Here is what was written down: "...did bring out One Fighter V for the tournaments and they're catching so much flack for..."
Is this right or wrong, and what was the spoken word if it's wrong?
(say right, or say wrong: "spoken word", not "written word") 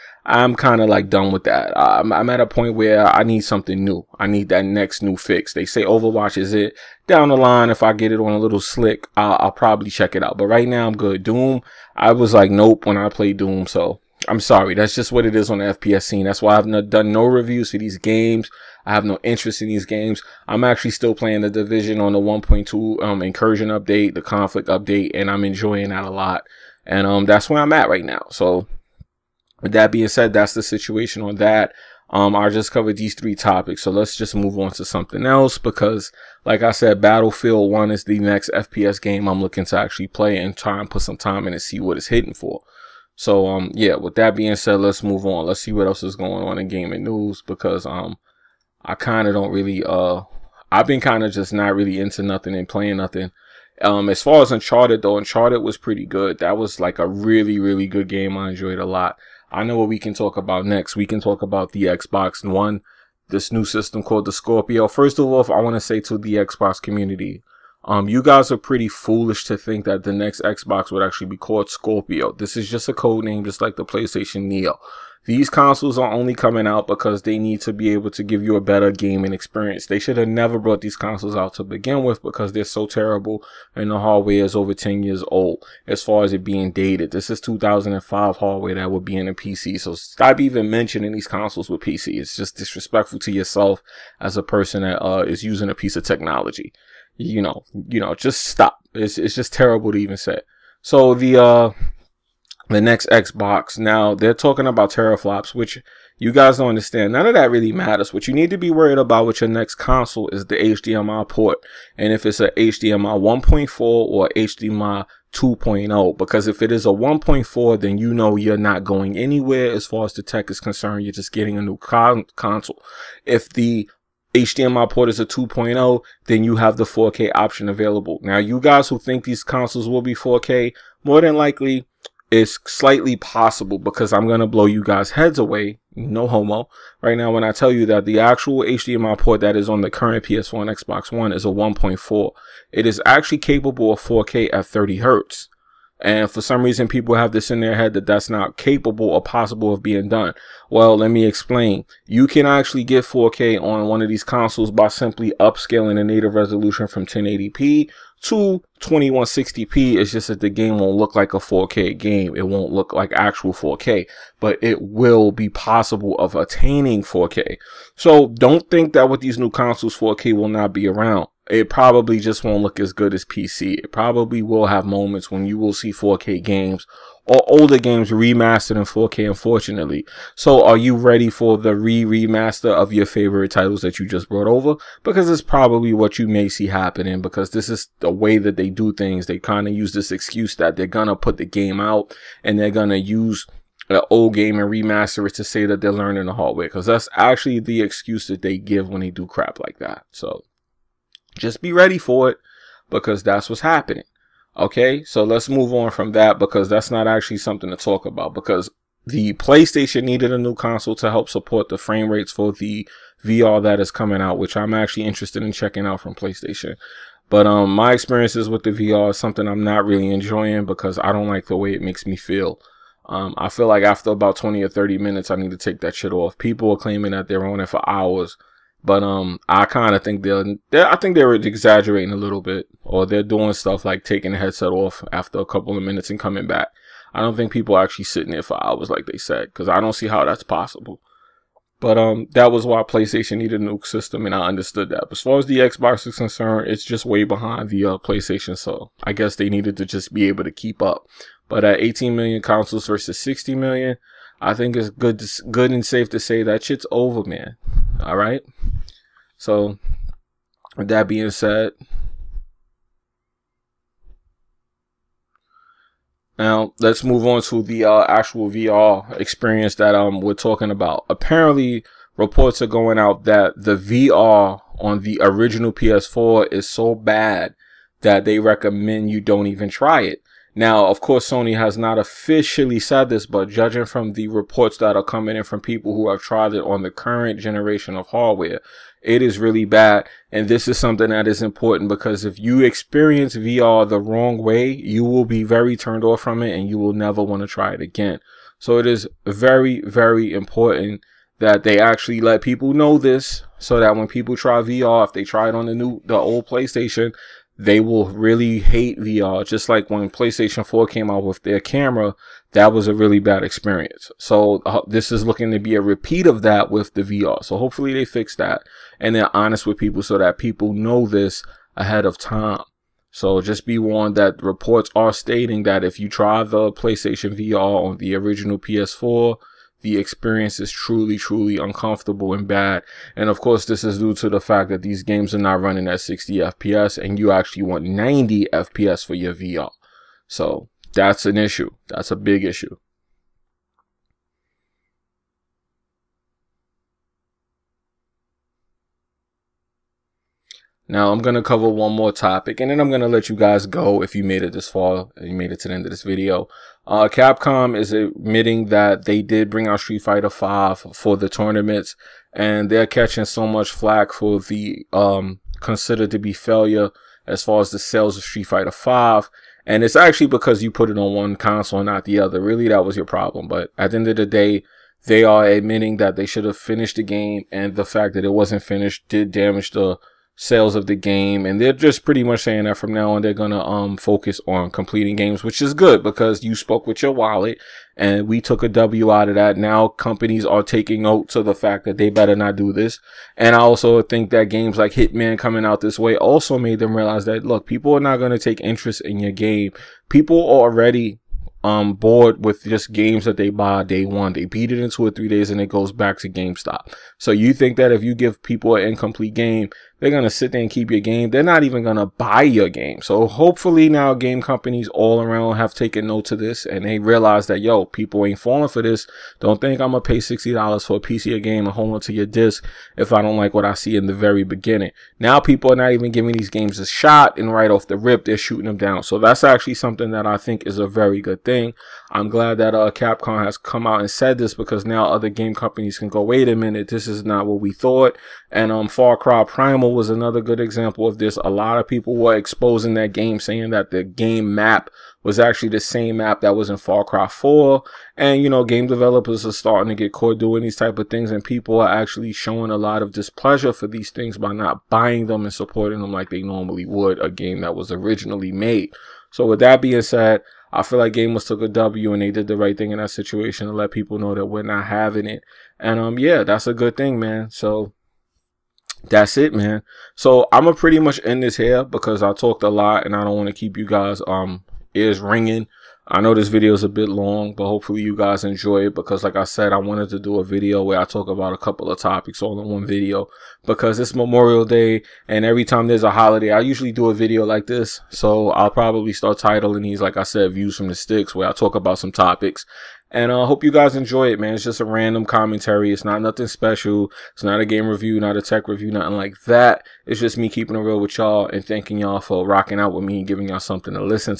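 wrong: "Street", not "One".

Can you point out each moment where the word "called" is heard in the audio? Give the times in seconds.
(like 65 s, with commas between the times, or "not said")
64 s, 71 s.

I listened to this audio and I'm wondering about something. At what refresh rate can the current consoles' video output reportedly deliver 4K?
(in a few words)
30 hertz.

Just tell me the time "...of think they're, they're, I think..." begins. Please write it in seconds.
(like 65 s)
229 s.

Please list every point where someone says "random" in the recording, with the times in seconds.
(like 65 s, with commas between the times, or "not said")
494 s.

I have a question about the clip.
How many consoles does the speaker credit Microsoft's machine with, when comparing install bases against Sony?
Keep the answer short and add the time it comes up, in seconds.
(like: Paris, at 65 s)
18 million, at 251 s.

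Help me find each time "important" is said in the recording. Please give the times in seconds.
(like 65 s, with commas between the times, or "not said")
291 s, 300 s.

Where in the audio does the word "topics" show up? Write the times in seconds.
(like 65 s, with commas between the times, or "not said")
33 s, 352 s, 481 s, 492 s.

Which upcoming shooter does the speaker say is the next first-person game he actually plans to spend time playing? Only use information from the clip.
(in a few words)
Battlefield 1.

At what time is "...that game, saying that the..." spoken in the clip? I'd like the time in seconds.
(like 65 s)
442 s.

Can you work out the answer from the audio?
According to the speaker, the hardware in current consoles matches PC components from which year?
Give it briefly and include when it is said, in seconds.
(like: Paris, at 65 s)
2005, at 87 s.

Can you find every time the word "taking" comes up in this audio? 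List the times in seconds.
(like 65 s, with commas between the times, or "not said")
234 s, 390 s.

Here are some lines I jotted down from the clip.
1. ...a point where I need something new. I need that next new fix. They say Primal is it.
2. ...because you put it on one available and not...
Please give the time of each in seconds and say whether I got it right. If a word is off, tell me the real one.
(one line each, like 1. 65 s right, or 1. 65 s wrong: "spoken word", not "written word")
1. 2 s wrong: "Overwatch", not "Primal"
2. 370 s wrong: "console", not "available".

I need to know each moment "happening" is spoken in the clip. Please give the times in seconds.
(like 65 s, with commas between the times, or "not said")
186 s, 203 s.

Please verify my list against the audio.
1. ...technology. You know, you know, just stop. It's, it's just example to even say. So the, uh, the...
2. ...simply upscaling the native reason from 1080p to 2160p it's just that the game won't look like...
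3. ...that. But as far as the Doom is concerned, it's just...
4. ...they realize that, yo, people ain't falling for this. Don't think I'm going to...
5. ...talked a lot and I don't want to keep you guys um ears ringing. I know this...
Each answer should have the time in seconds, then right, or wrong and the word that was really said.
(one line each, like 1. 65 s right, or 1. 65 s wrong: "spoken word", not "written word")
1. 96 s wrong: "terrible", not "example"
2. 154 s wrong: "resolution", not "reason"
3. 244 s wrong: "Xbox", not "Doom"
4. 416 s right
5. 472 s right.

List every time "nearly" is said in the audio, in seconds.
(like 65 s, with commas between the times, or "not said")
not said.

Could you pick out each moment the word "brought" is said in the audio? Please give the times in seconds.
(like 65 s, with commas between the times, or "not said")
80 s, 184 s.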